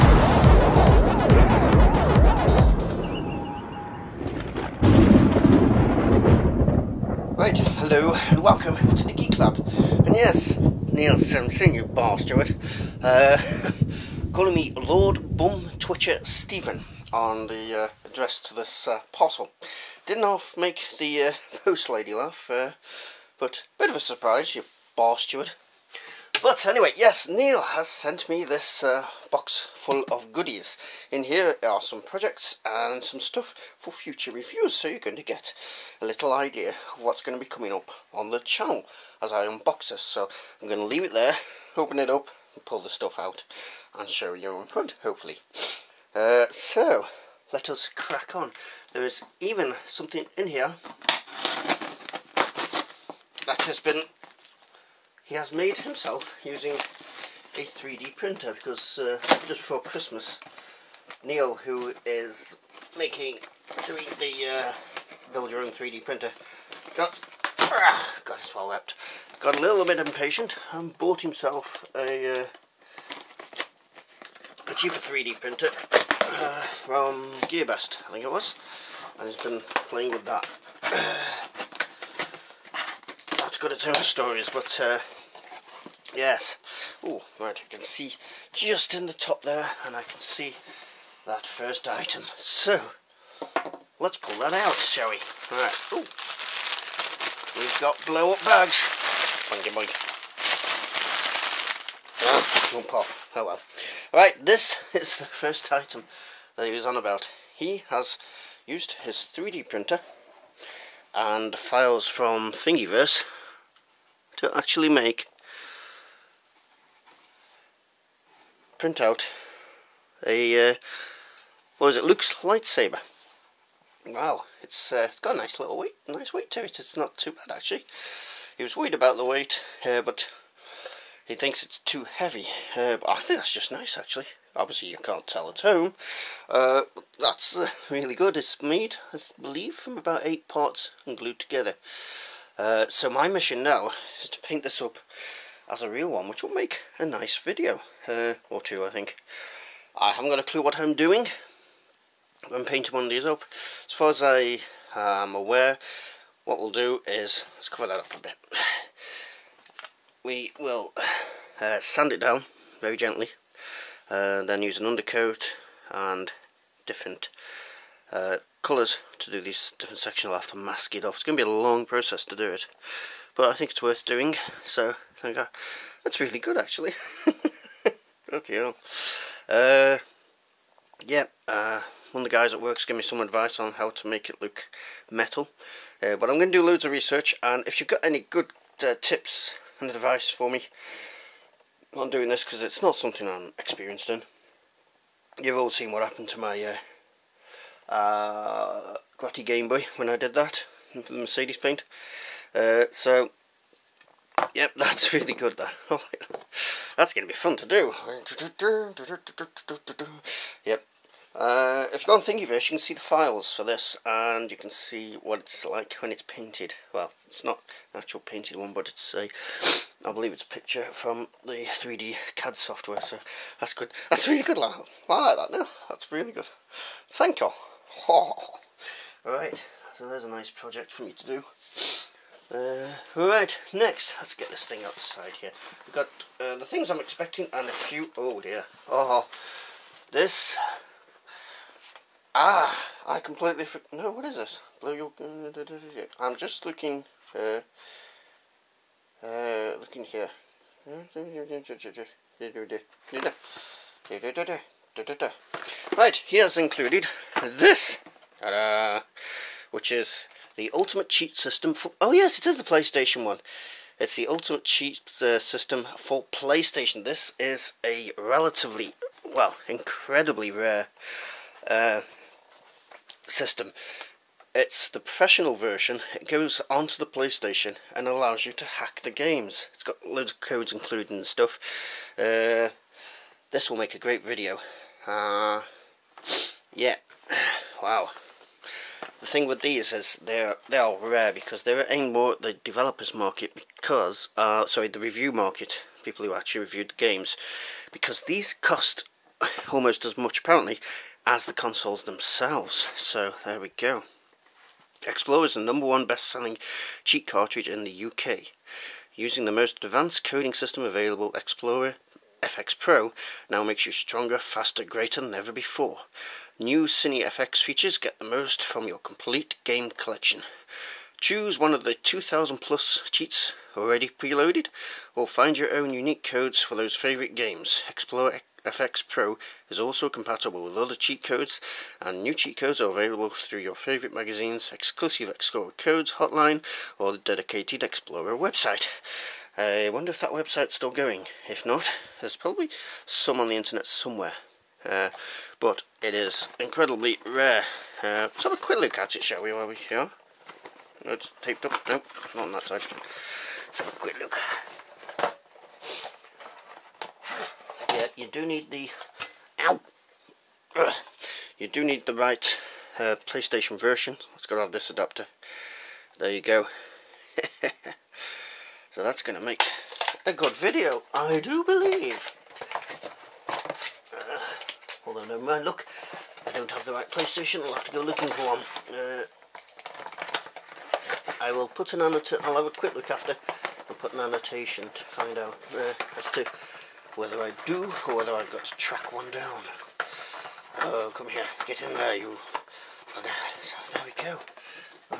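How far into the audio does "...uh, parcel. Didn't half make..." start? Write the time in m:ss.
0:18.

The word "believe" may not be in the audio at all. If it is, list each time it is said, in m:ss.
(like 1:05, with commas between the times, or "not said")
2:19, 3:40, 6:11.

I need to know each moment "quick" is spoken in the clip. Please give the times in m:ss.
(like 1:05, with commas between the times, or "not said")
5:48, 5:53, 6:22.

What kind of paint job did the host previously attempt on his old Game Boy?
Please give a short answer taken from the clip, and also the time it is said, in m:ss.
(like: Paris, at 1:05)
Mercedes paint, at 3:21.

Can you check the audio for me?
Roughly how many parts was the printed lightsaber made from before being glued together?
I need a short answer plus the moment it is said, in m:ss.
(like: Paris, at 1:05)
8, at 2:20.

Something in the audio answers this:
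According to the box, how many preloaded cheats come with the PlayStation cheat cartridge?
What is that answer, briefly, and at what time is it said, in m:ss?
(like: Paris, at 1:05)
2000 plus, at 5:21.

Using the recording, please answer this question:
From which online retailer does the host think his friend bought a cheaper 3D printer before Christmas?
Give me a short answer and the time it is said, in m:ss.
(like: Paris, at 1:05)
Gearbest, at 1:17.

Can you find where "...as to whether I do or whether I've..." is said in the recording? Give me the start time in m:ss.
6:26.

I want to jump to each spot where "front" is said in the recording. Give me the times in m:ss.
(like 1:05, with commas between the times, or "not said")
0:44.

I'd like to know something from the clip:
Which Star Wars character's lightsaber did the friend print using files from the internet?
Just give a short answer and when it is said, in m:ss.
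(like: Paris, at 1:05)
Luke, at 2:02.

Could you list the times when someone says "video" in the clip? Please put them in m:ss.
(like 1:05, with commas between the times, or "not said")
2:27, 4:44, 6:10.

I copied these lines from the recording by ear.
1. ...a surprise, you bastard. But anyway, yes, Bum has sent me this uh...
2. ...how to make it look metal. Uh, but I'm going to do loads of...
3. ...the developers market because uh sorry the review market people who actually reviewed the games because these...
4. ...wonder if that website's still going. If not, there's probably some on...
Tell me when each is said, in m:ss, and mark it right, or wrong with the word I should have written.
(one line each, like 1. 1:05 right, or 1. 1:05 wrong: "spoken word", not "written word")
1. 0:23 wrong: "Neil", not "Bum"
2. 3:03 right
3. 4:52 right
4. 5:39 right.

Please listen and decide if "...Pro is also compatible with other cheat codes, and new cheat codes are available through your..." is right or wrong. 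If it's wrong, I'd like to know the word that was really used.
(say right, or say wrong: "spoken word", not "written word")
right.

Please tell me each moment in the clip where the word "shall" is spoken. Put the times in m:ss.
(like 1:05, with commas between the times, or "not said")
1:34, 5:49.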